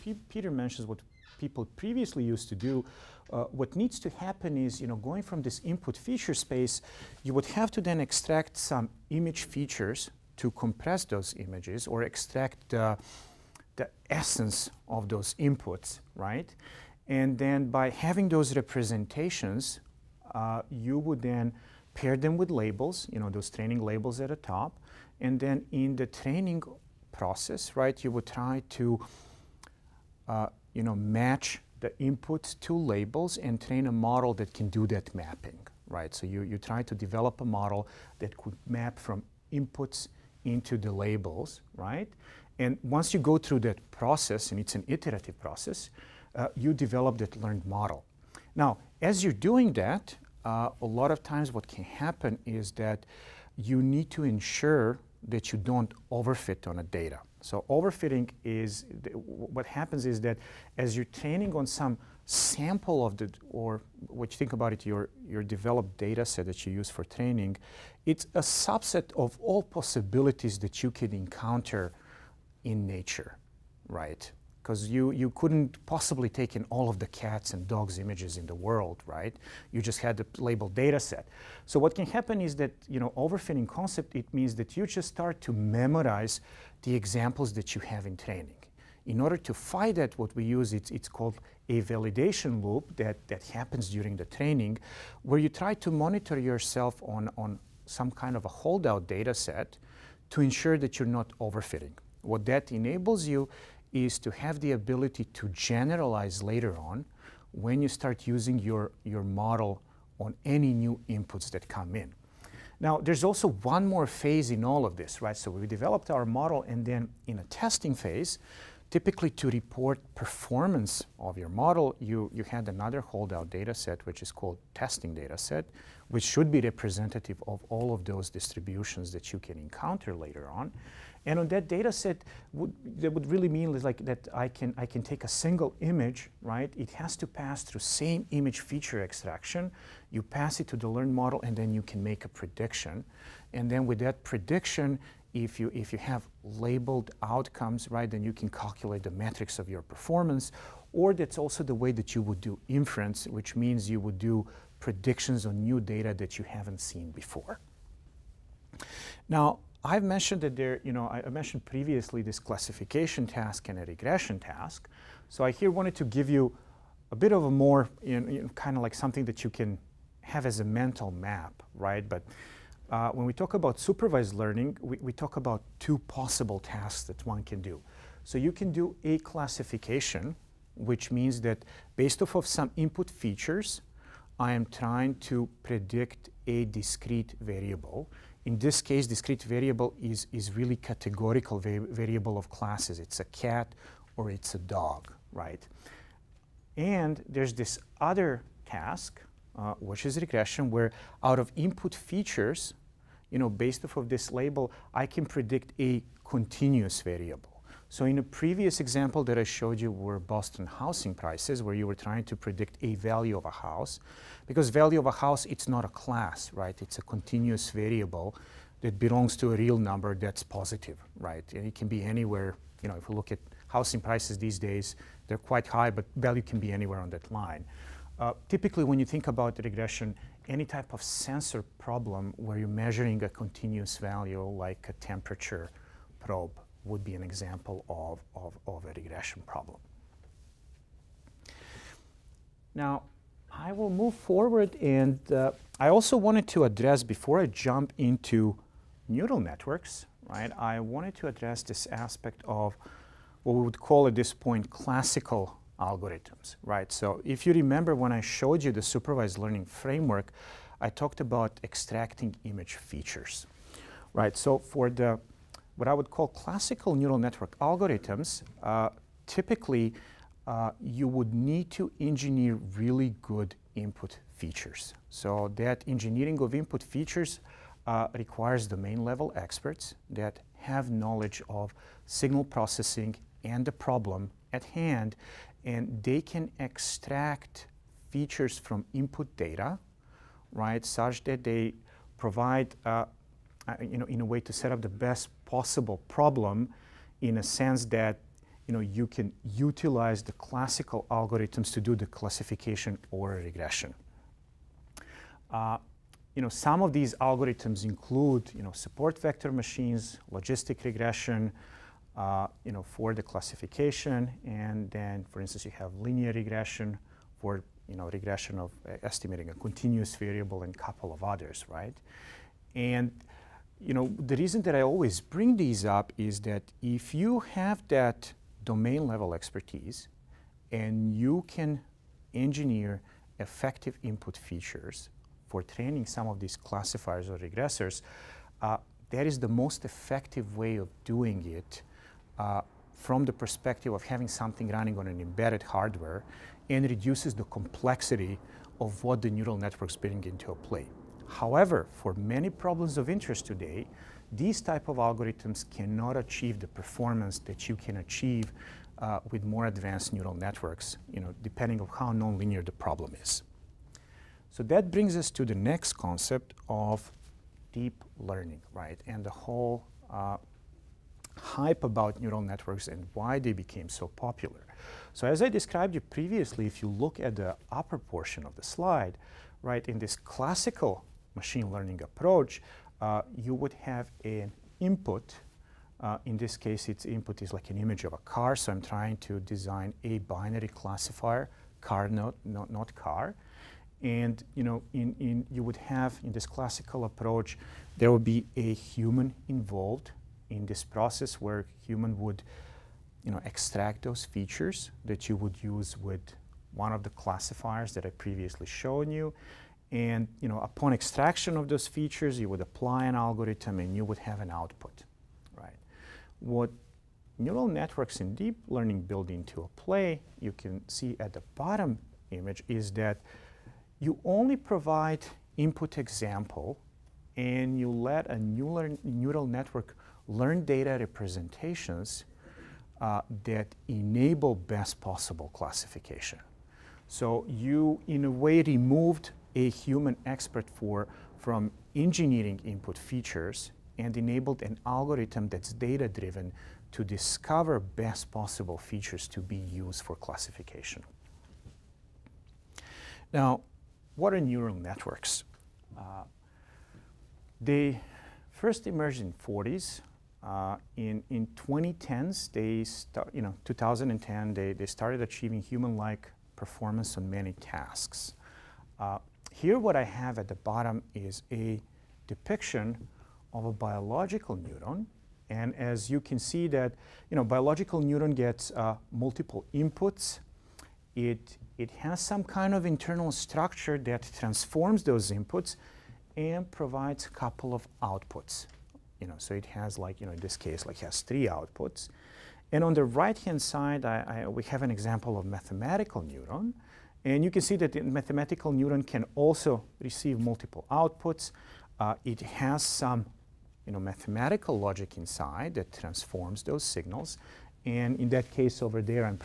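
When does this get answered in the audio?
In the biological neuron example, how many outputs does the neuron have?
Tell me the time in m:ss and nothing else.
8:11.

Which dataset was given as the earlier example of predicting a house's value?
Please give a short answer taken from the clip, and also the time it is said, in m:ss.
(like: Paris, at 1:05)
Boston housing prices, at 3:30.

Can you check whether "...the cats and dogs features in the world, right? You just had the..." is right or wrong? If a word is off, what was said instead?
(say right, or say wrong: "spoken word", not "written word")
wrong: "images", not "features".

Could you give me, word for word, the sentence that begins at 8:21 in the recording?
Uh, it has some you know, mathematical logic inside that transforms those signals.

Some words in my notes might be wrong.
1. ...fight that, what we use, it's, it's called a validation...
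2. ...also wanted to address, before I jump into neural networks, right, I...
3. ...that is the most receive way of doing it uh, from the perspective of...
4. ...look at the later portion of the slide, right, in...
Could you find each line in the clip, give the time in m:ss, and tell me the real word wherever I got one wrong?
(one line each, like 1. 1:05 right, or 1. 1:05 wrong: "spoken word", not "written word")
1. 1:29 right
2. 4:05 right
3. 5:39 wrong: "effective", not "receive"
4. 6:16 wrong: "upper", not "later".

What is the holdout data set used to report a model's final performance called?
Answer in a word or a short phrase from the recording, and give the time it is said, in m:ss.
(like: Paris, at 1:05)
testing data set, at 2:04.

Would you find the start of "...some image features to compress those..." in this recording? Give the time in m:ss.
0:08.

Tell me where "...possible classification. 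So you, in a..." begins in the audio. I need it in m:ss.
7:14.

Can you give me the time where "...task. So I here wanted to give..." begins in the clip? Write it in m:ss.
2:44.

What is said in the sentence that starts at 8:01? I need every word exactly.
It, it has some kind of internal structure that transforms those inputs and provides a couple of outputs.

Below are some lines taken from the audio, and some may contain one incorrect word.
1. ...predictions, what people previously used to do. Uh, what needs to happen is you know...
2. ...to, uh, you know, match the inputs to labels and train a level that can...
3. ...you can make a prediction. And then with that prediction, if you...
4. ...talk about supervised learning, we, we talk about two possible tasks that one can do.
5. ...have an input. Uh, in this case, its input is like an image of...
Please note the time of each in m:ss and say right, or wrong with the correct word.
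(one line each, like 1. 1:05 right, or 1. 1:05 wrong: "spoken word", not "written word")
1. 0:00 wrong: "mentions", not "predictions"
2. 0:28 wrong: "model", not "level"
3. 2:21 right
4. 2:53 right
5. 6:23 right.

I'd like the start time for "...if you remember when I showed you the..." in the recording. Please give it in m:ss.
4:17.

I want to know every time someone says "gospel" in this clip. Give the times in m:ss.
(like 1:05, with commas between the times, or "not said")
not said.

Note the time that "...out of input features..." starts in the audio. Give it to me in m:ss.
3:21.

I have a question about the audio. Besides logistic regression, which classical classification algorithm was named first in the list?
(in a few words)
support vector machines.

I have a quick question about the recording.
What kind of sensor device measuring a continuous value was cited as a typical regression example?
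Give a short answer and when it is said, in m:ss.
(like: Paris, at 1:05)
temperature probe, at 3:54.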